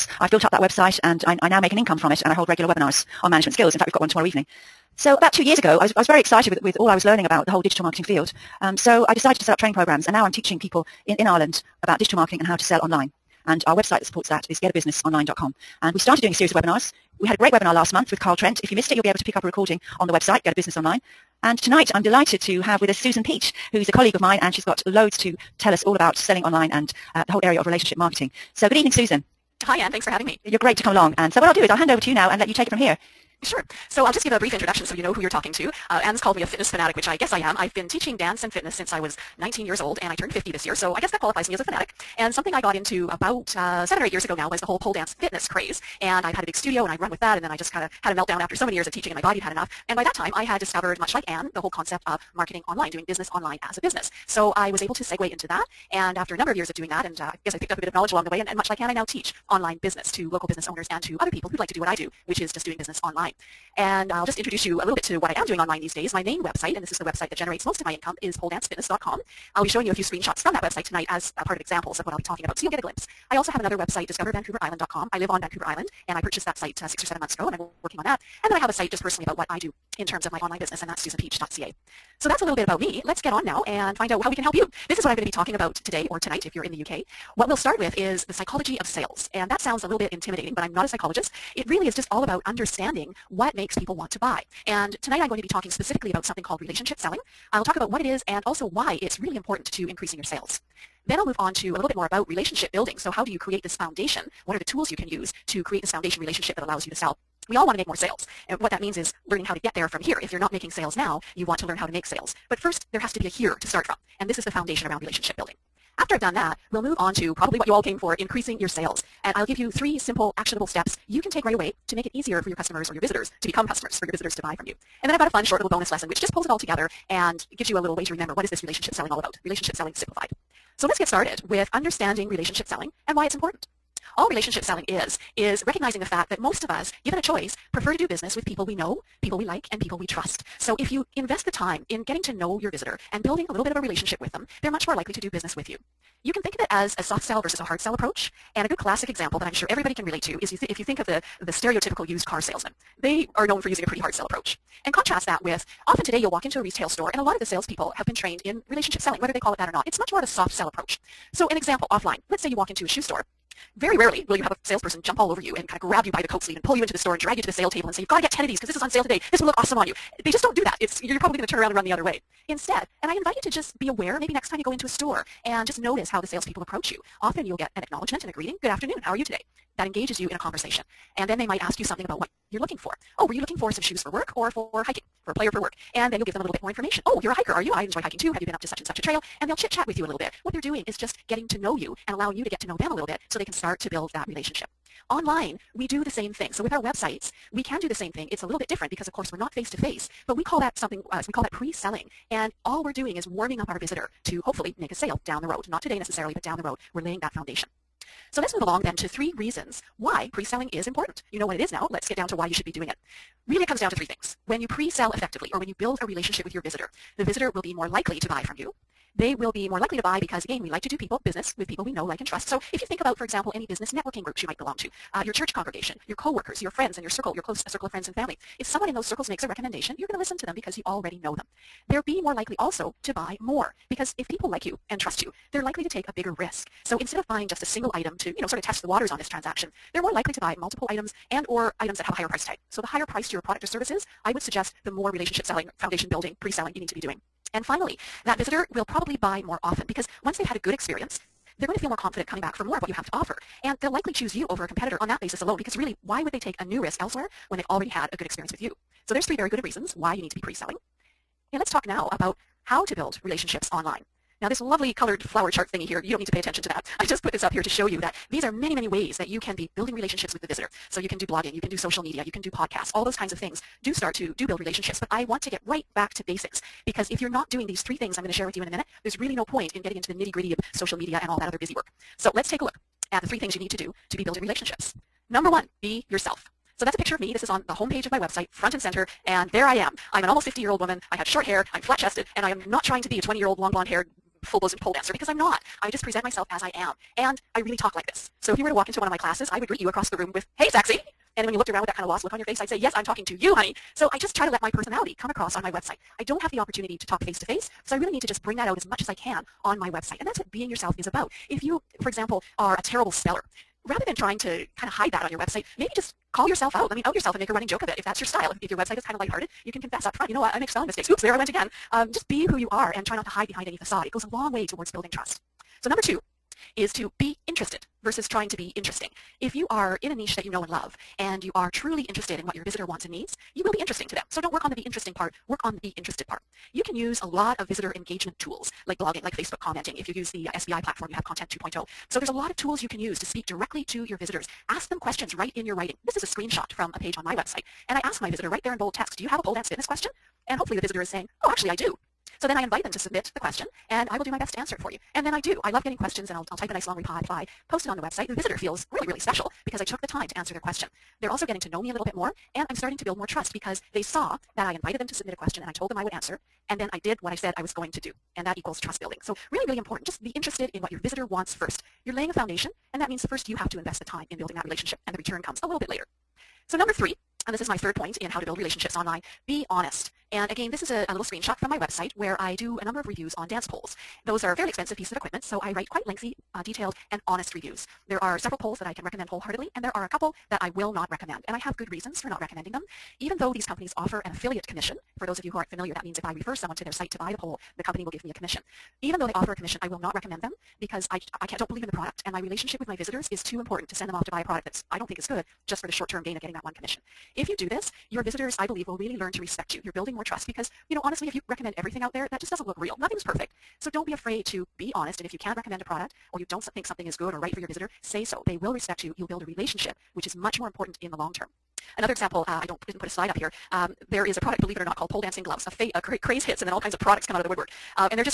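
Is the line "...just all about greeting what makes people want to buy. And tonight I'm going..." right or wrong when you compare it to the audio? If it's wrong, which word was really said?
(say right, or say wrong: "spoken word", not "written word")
wrong: "understanding", not "greeting".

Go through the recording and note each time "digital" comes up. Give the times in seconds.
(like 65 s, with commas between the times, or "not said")
7 s, 11 s.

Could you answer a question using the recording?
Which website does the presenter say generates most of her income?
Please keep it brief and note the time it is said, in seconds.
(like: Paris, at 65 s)
poledancefitness.com, at 68 s.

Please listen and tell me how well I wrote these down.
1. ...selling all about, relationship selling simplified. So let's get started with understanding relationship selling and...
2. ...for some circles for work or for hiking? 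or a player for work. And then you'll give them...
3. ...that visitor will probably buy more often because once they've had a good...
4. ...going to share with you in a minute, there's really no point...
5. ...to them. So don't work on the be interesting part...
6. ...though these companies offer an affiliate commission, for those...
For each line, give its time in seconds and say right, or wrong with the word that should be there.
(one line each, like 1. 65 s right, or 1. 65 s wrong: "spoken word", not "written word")
1. 128 s right
2. 183 s wrong: "shoes", not "circles"
3. 248 s right
4. 278 s right
5. 334 s right
6. 393 s right.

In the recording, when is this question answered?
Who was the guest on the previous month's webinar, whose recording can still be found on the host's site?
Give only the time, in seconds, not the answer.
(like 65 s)
18 s.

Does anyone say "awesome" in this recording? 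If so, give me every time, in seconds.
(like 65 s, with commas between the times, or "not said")
169 s.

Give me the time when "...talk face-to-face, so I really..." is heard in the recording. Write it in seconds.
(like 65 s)
307 s.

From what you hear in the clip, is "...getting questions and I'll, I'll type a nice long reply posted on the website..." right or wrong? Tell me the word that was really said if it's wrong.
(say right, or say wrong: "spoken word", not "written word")
right.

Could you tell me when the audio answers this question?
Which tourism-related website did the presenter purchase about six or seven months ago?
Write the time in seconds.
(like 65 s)
74 s.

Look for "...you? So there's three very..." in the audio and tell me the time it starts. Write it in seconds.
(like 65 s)
258 s.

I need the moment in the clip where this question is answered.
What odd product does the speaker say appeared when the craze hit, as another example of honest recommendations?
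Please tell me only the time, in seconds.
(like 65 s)
425 s.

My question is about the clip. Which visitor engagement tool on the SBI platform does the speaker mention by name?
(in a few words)
Content 2.0.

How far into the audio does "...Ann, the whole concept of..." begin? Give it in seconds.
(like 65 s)
51 s.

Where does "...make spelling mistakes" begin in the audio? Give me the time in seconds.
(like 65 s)
320 s.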